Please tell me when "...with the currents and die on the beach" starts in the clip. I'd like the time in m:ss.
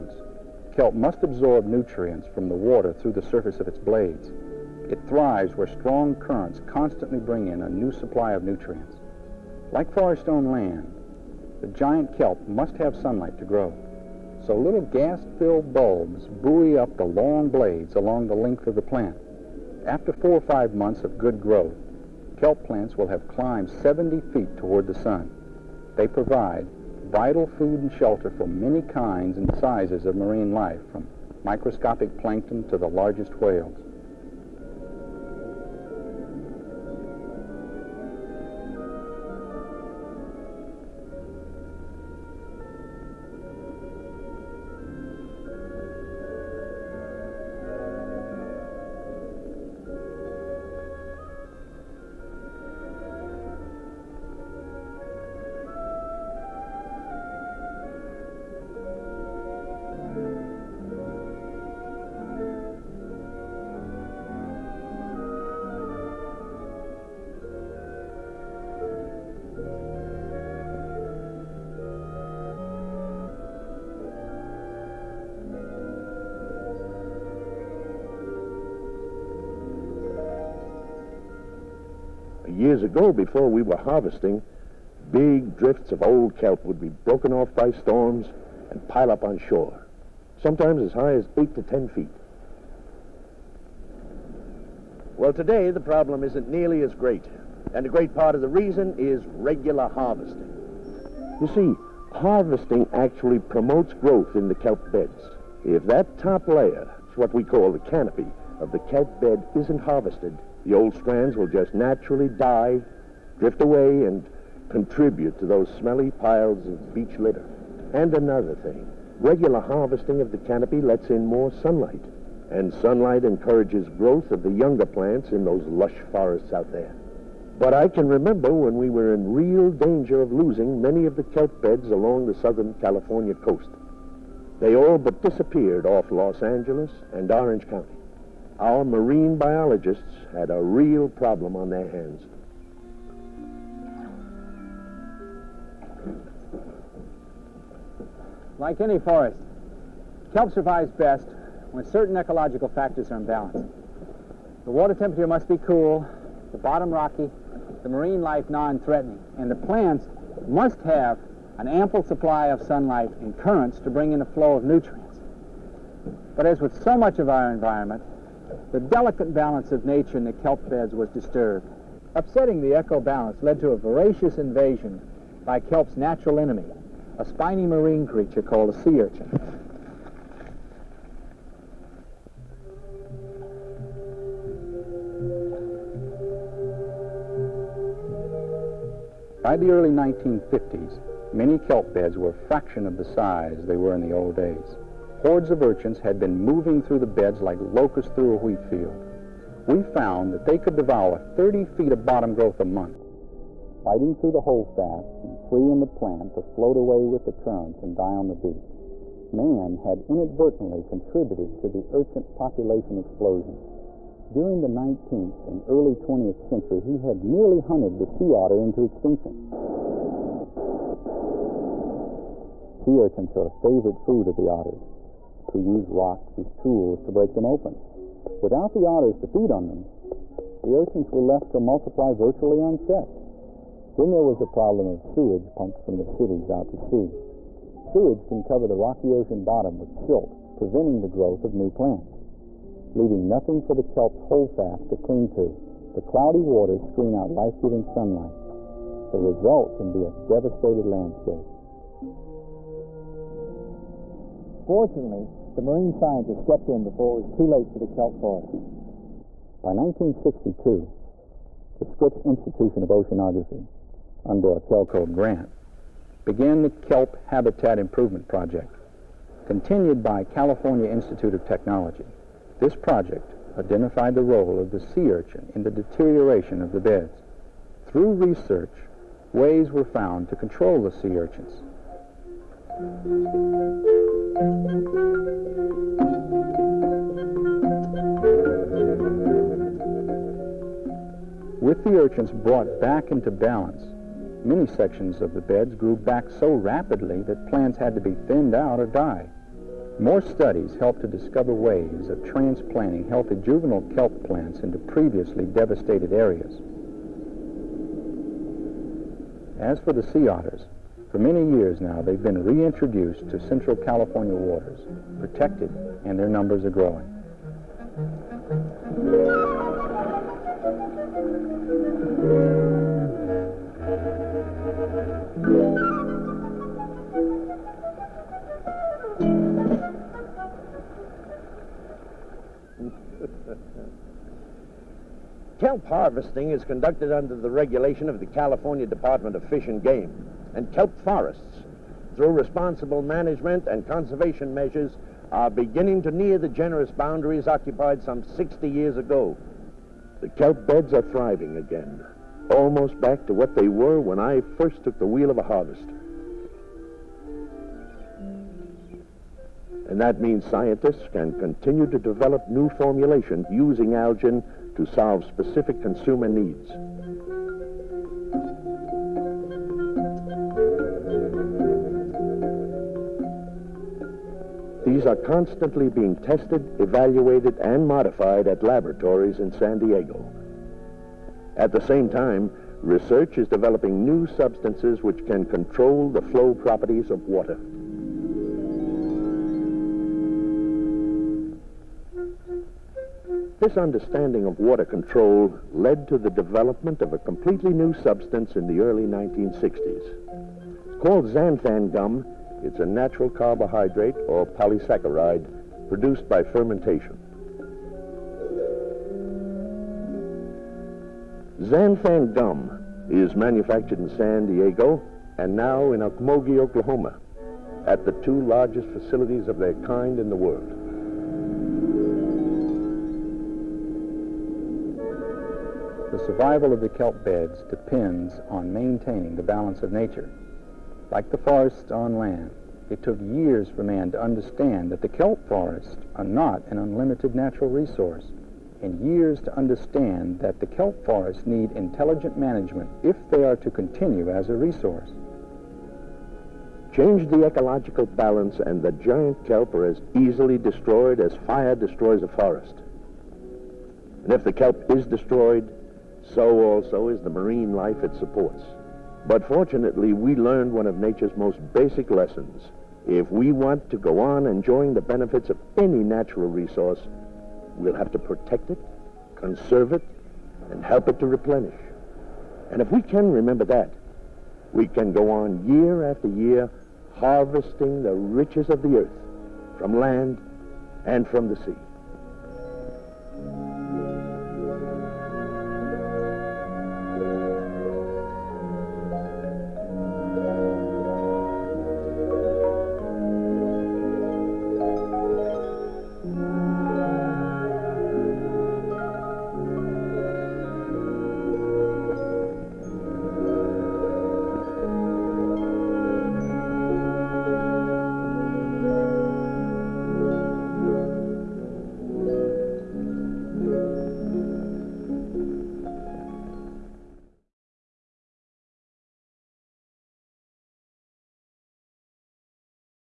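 3:27.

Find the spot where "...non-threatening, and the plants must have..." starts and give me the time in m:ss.
2:38.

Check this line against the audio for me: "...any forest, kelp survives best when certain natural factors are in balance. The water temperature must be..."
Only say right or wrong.
wrong.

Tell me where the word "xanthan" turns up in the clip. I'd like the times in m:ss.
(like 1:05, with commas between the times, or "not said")
6:41, 6:51.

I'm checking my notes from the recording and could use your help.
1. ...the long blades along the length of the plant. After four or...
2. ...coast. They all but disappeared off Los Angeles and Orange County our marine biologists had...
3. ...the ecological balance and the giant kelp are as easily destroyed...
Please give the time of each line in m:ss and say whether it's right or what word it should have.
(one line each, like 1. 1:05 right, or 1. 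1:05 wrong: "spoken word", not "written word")
1. 0:16 right
2. 2:13 right
3. 7:27 right.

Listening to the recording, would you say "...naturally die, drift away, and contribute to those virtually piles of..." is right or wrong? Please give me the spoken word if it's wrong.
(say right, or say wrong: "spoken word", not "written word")
wrong: "smelly", not "virtually".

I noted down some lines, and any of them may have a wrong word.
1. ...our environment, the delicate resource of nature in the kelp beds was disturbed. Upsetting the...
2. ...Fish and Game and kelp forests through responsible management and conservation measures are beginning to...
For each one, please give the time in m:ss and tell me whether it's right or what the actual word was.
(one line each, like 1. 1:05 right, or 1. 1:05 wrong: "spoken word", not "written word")
1. 2:47 wrong: "balance", not "resource"
2. 5:39 right.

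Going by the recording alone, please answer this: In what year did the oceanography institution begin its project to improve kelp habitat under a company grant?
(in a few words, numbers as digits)
1962.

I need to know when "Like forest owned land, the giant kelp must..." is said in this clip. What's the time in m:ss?
0:09.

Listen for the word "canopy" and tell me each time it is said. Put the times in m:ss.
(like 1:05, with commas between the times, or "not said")
1:47, 2:00.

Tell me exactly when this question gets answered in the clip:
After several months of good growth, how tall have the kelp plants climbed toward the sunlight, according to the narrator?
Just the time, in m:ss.
0:23.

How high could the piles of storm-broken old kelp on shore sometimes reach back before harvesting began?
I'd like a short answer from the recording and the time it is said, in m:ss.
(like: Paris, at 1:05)
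8 to 10 feet, at 1:31.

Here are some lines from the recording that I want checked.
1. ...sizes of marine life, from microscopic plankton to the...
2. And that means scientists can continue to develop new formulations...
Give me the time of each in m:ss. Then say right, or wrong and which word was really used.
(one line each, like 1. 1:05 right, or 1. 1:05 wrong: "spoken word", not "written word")
1. 0:29 right
2. 5:59 right.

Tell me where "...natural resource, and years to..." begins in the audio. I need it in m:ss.
7:17.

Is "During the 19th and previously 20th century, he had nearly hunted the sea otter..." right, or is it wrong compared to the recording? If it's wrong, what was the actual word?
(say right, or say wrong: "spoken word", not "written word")
wrong: "early", not "previously".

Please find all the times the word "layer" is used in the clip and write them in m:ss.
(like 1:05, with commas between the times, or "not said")
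1:46.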